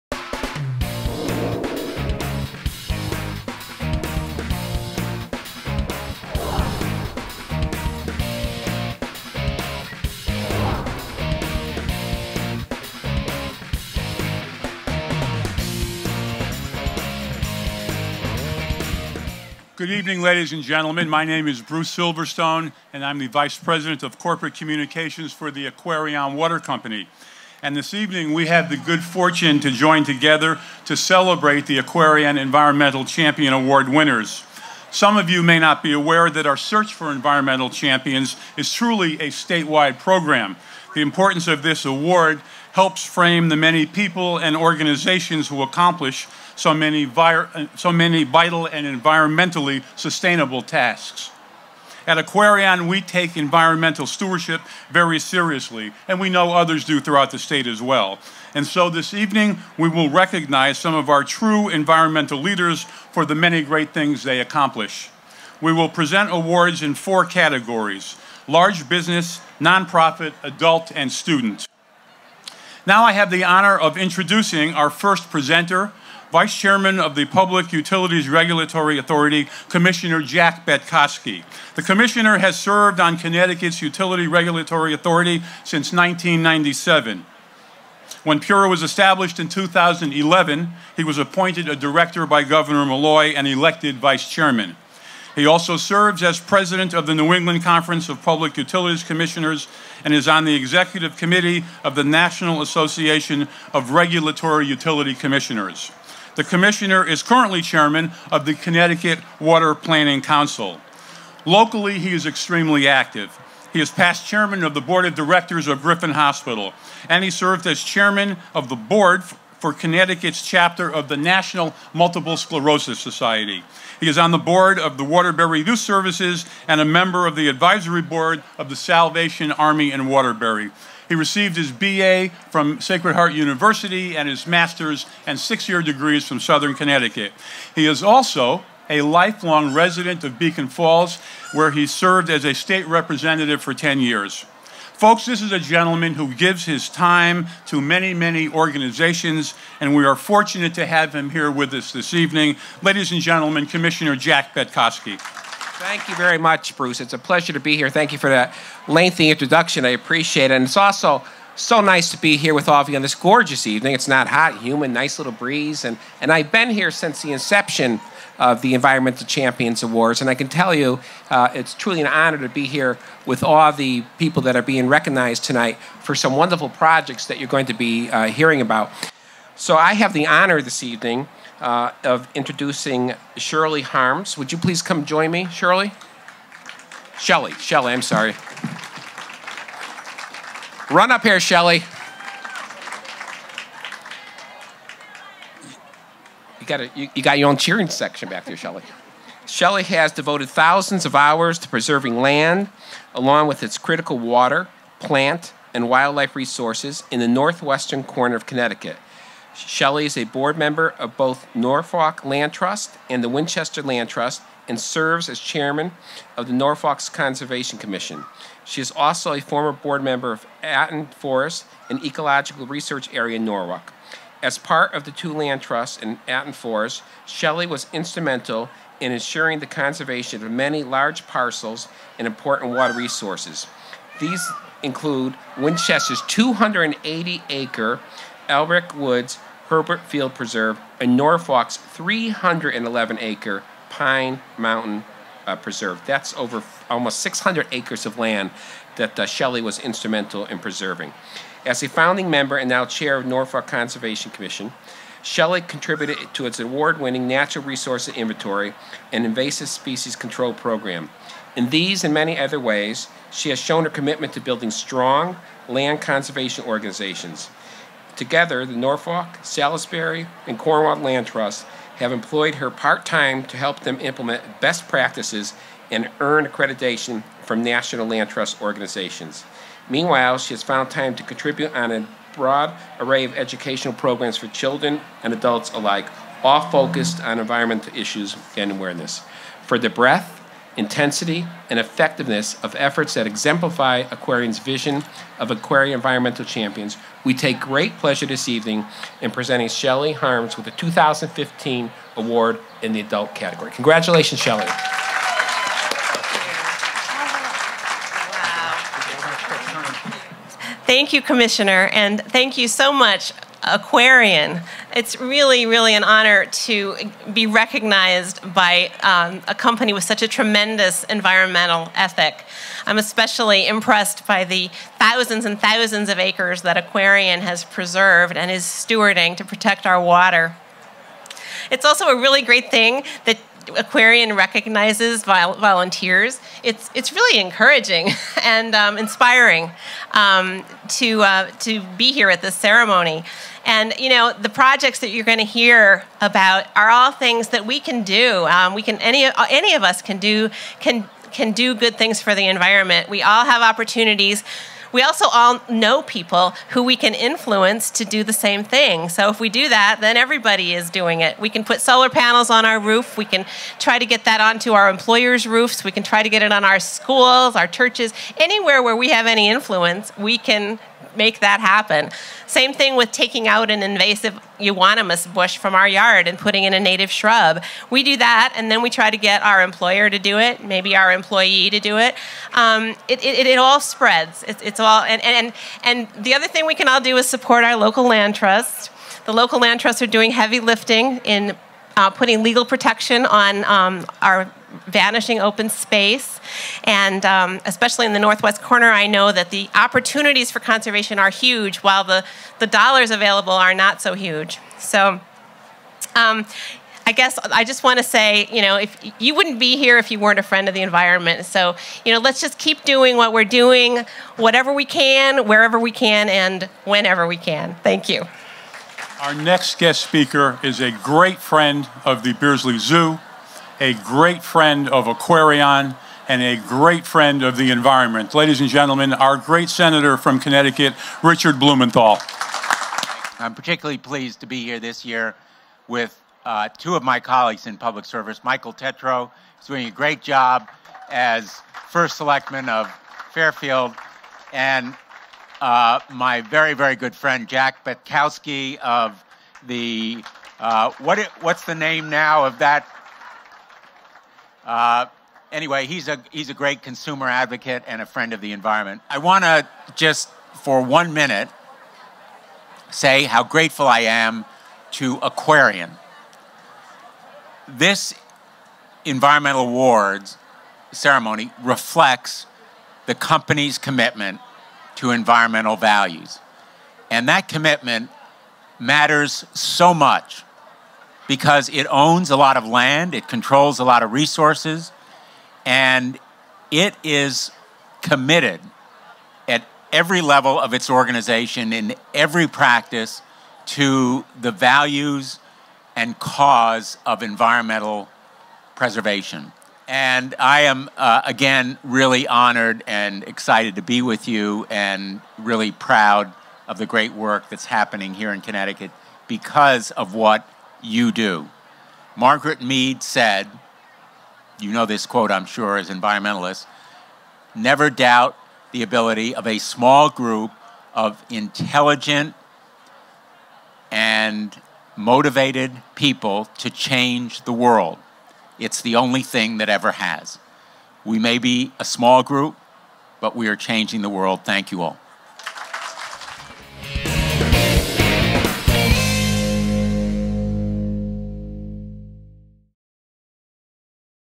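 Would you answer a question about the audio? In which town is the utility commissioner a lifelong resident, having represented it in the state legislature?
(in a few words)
Beacon Falls.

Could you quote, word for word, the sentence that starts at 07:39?
I want to just for one minute say how grateful I am to Aquarion.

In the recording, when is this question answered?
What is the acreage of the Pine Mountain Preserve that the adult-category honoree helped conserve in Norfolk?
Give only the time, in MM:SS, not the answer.
04:01.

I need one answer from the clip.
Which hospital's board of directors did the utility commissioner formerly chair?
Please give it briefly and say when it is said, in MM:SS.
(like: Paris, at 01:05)
Griffin Hospital, at 01:55.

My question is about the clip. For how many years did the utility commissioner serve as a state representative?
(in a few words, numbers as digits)
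10.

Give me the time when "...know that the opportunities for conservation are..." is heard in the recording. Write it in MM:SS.
06:39.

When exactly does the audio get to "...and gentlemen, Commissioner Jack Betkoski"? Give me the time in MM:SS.
02:33.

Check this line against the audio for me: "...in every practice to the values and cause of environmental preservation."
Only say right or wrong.
right.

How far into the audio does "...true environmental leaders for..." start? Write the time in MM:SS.
01:01.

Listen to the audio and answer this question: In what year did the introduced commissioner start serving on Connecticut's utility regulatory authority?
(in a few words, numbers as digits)
1997.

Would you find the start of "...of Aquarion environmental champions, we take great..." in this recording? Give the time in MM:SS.
04:55.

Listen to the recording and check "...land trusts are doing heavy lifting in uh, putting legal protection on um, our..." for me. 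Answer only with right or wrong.
right.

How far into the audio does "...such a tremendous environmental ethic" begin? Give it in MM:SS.
05:20.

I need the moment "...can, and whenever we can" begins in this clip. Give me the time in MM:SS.
06:55.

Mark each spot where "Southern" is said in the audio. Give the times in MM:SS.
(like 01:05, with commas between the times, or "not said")
02:16.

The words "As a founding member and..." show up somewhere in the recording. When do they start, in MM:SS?
04:11.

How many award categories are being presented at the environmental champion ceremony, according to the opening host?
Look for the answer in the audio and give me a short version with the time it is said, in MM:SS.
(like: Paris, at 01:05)
4, at 01:06.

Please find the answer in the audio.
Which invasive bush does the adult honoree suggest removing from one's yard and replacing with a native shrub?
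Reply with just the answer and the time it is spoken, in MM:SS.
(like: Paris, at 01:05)
Euonymus, at 06:14.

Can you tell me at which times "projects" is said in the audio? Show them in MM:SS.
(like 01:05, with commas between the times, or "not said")
02:56, 05:44.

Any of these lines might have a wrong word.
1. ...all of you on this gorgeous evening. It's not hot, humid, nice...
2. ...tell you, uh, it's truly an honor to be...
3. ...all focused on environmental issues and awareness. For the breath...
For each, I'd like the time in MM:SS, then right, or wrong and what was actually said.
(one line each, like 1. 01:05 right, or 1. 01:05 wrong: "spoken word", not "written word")
1. 02:42 right
2. 02:50 right
3. 04:46 right.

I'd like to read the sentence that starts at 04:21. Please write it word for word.
In these and many other ways, she has shown her commitment to building strong land conservation organizations.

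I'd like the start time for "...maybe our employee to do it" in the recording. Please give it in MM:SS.
06:20.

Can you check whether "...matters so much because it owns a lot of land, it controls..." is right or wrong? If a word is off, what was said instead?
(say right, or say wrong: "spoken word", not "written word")
right.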